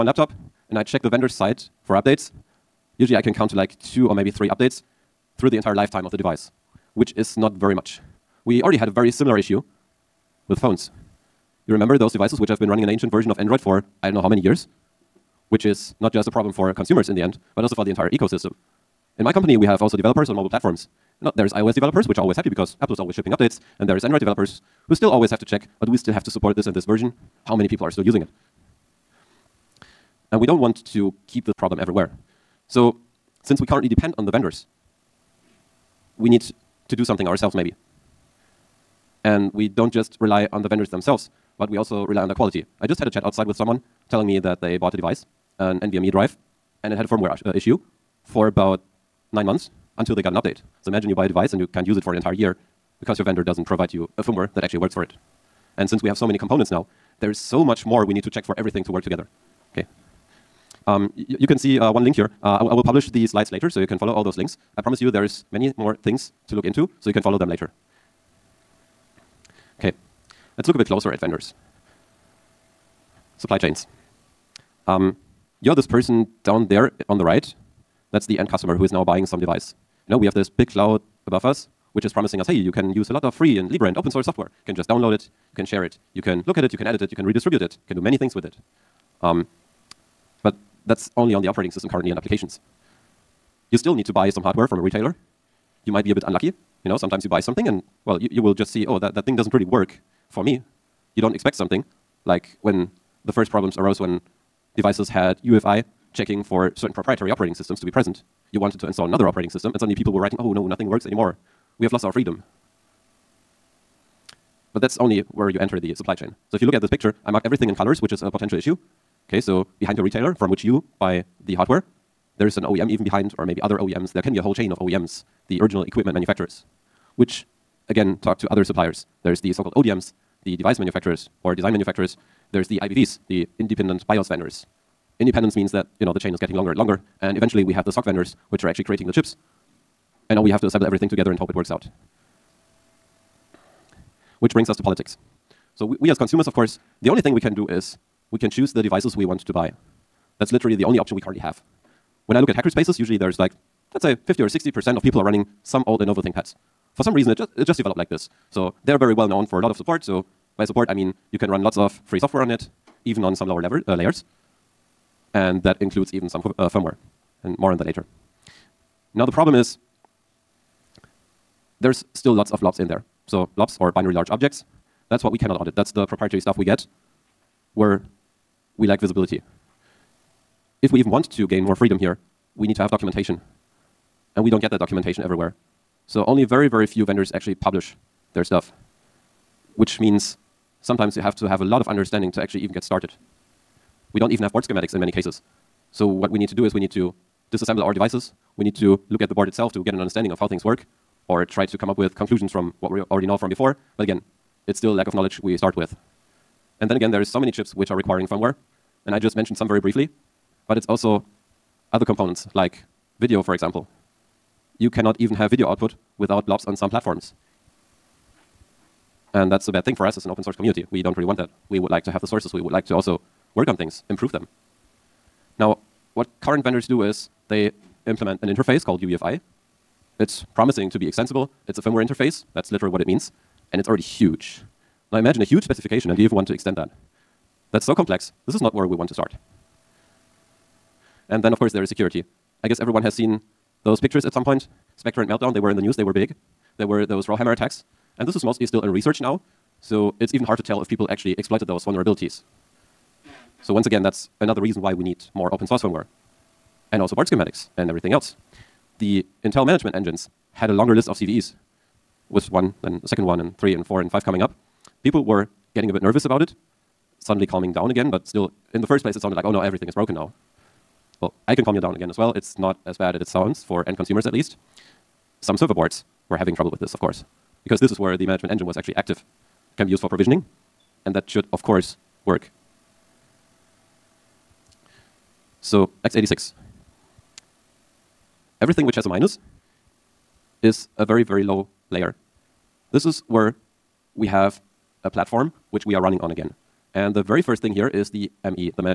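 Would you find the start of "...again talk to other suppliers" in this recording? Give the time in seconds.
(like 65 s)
127 s.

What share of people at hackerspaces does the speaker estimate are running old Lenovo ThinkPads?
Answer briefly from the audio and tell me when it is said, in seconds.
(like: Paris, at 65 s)
50 or 60%, at 154 s.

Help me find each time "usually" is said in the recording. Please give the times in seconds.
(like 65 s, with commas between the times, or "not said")
2 s, 152 s.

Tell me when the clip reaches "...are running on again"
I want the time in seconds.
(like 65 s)
295 s.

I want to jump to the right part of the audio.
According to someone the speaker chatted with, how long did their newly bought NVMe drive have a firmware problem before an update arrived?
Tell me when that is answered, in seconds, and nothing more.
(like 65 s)
49 s.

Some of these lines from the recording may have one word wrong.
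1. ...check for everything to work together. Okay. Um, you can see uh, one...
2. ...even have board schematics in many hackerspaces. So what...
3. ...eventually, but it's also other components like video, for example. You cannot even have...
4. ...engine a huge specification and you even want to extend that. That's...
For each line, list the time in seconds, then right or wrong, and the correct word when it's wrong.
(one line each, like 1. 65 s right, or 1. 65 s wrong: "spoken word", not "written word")
1. 58 s right
2. 194 s wrong: "cases", not "hackerspaces"
3. 209 s wrong: "briefly", not "eventually"
4. 235 s wrong: "imagine", not "engine".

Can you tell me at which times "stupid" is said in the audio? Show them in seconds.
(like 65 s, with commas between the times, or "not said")
not said.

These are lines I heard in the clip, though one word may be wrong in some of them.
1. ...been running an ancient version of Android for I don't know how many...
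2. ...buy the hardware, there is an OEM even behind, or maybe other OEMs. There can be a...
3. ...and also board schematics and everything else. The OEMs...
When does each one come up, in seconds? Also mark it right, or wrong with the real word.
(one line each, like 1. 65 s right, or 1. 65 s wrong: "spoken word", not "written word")
1. 12 s right
2. 120 s right
3. 256 s wrong: "Intel", not "OEMs".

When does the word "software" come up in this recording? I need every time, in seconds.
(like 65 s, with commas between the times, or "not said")
84 s, 162 s.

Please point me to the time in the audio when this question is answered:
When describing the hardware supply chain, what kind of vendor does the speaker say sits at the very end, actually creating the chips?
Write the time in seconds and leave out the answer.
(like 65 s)
137 s.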